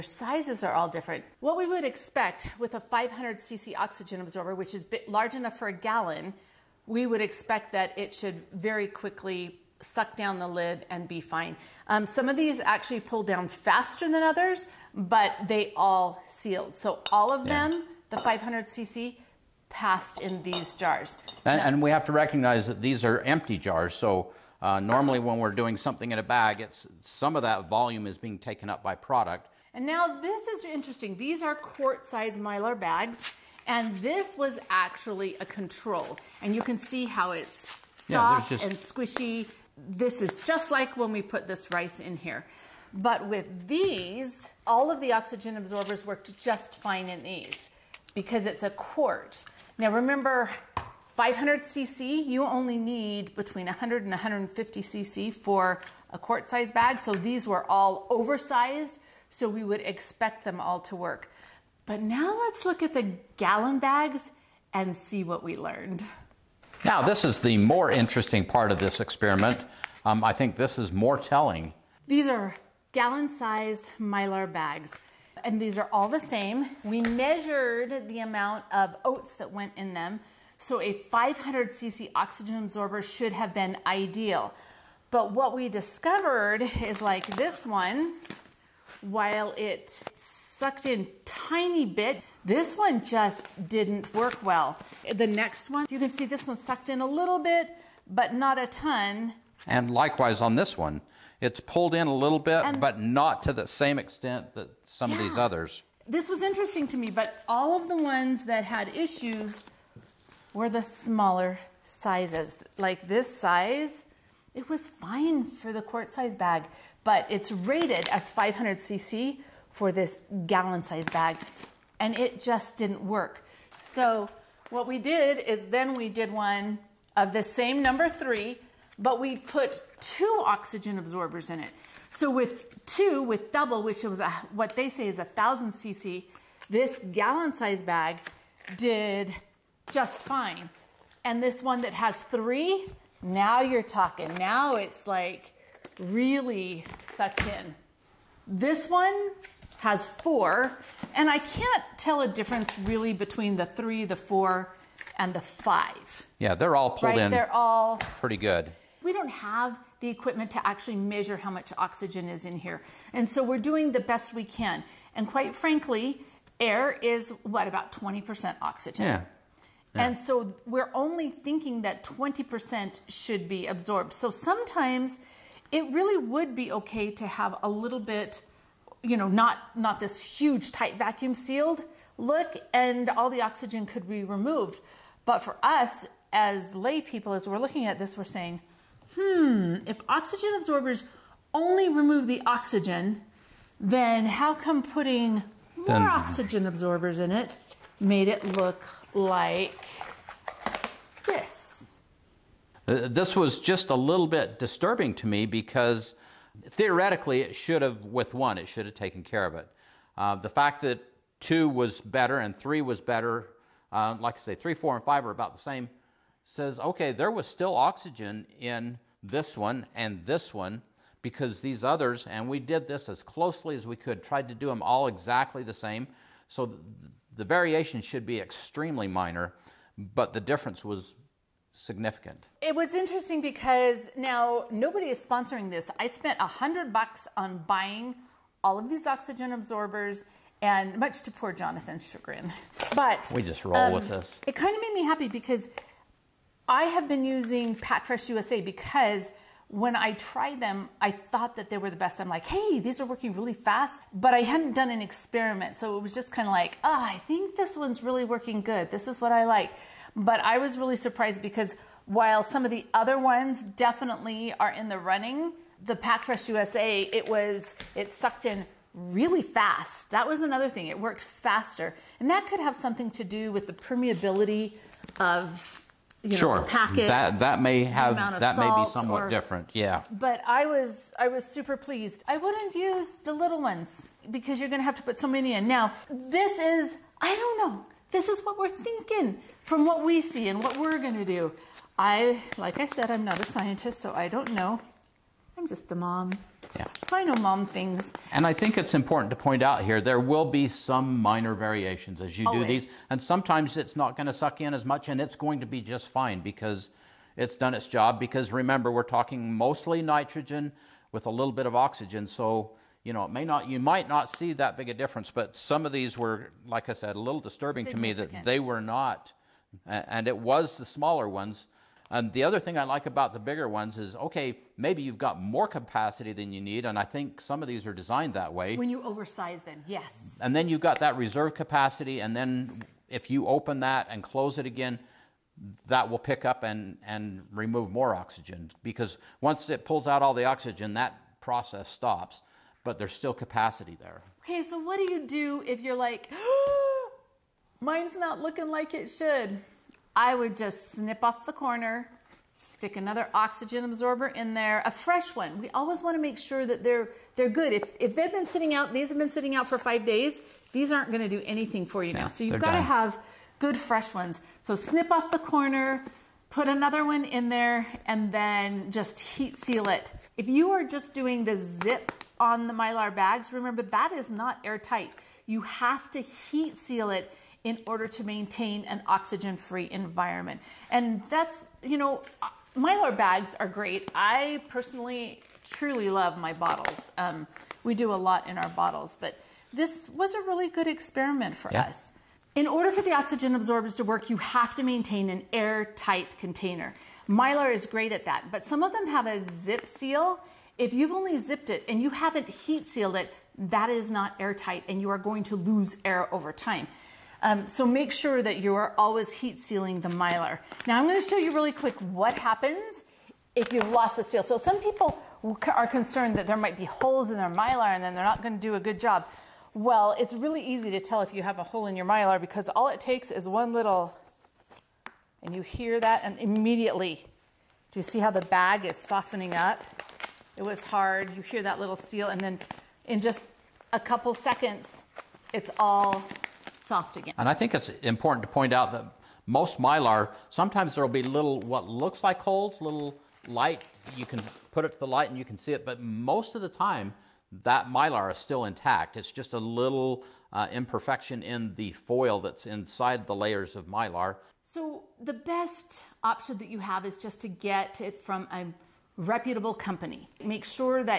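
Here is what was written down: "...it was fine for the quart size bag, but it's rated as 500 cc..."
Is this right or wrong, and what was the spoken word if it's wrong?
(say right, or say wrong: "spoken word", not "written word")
right.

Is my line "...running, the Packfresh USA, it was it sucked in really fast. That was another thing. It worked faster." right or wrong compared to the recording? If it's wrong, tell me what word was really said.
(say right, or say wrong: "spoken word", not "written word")
right.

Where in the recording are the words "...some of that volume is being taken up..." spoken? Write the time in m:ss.
0:27.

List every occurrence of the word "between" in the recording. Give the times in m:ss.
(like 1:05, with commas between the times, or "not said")
0:53, 2:33.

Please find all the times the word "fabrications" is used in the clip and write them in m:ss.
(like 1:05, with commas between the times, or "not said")
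not said.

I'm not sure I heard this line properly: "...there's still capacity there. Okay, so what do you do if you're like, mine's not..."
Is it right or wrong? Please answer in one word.
right.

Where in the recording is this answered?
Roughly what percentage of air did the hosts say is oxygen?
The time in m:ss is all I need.
2:47.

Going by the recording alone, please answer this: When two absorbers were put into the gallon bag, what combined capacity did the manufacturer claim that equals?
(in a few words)
1000 cc.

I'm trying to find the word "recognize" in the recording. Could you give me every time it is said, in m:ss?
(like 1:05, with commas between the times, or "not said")
0:22.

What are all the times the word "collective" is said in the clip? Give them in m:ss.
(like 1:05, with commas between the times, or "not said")
not said.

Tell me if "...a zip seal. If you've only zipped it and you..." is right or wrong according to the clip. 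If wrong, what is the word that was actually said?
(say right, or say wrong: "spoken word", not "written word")
right.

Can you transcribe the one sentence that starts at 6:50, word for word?
Now I'm gonna show you really quick what happens if you've lost the seal.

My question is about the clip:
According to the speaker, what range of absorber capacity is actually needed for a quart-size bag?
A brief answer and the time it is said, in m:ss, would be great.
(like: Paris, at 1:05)
100 to 150 cc, at 0:53.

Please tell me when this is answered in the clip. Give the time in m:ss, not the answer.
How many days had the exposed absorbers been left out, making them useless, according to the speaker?
5:59.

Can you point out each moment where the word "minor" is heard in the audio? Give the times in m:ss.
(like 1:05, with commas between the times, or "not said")
3:49, 5:01.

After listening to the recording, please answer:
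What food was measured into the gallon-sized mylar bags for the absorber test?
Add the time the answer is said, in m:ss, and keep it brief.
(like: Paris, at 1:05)
oats, at 1:19.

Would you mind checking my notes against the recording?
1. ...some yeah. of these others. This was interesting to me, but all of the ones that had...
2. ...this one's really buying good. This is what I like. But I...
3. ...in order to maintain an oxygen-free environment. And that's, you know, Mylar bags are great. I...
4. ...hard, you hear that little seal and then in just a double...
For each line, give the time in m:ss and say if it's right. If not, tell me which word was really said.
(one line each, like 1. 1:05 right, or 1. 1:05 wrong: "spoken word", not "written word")
1. 1:44 right
2. 4:17 wrong: "working", not "buying"
3. 6:17 right
4. 7:10 wrong: "couple", not "double".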